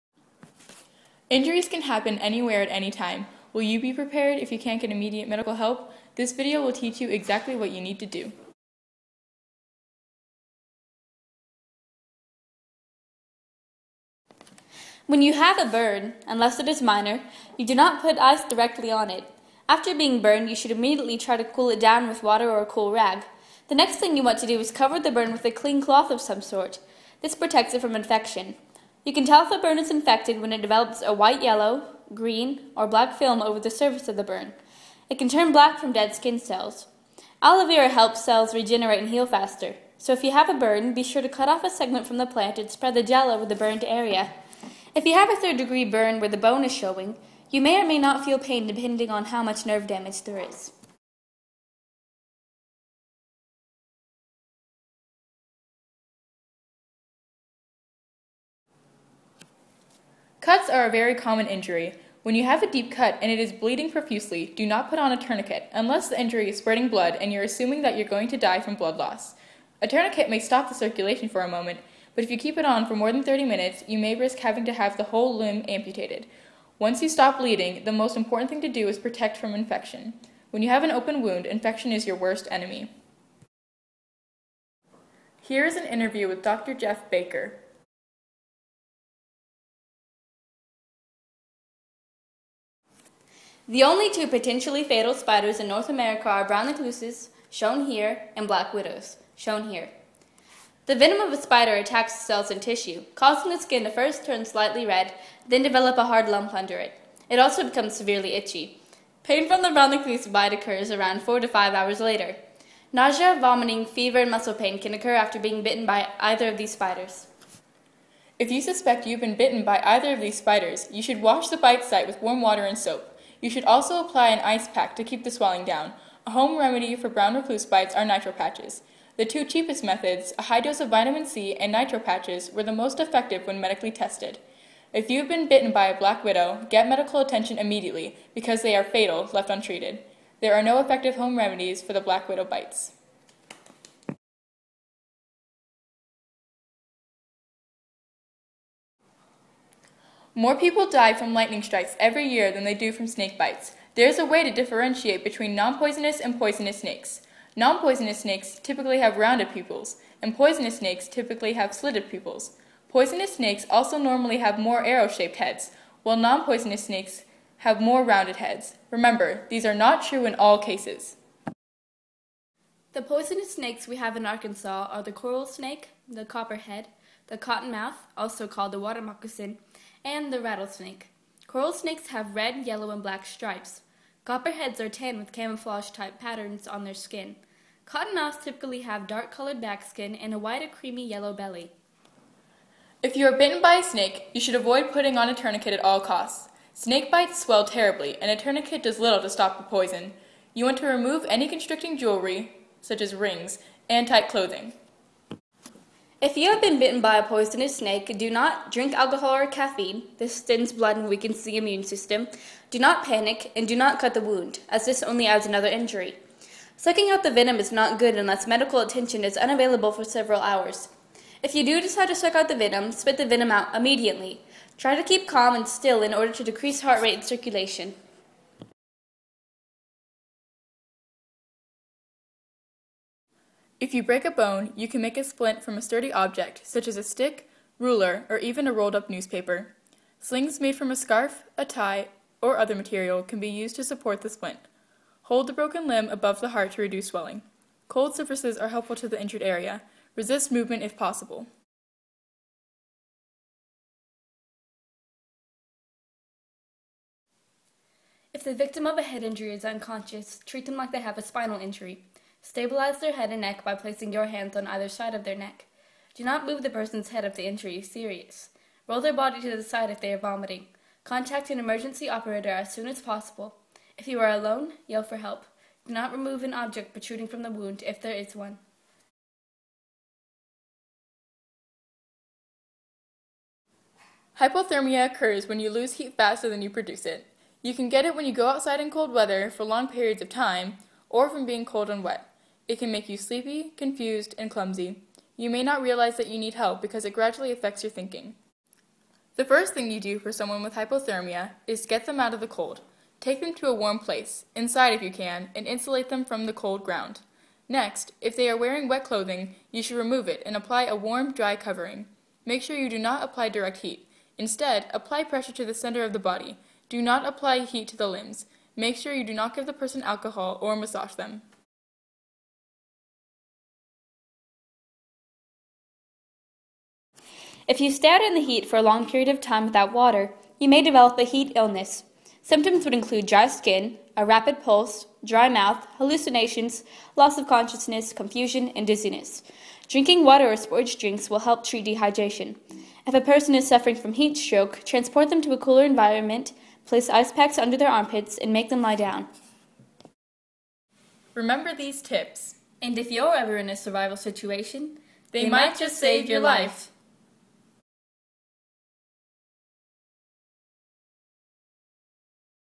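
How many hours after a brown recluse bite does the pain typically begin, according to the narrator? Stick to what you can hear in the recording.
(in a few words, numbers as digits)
4 to 5 hours.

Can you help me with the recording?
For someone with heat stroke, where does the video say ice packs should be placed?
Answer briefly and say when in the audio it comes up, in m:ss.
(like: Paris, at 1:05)
under their armpits, at 5:47.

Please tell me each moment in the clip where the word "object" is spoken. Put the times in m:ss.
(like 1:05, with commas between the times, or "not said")
3:56, 4:36.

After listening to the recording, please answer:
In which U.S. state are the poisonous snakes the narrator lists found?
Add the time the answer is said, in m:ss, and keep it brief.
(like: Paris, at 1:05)
Arkansas, at 2:54.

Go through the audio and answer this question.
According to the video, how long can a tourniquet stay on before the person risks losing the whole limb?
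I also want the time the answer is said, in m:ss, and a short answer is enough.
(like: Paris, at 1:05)
30 minutes, at 1:13.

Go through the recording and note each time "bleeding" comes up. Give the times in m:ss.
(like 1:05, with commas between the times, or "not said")
1:03, 1:17.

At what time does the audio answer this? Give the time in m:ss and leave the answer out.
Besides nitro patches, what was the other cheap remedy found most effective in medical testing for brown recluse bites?
2:10.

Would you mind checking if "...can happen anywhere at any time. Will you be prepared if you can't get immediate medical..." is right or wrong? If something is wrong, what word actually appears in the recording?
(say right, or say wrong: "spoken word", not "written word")
right.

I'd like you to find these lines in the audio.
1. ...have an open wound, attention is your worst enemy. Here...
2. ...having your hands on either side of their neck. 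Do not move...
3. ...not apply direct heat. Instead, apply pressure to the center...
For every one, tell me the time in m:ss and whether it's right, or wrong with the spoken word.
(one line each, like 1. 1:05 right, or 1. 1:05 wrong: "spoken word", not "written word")
1. 1:20 wrong: "infection", not "attention"
2. 4:23 wrong: "placing", not "having"
3. 5:12 right.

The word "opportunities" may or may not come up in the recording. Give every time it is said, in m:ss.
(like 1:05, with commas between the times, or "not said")
not said.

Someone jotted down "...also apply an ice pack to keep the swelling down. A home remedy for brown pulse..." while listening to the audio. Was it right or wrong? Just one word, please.
wrong.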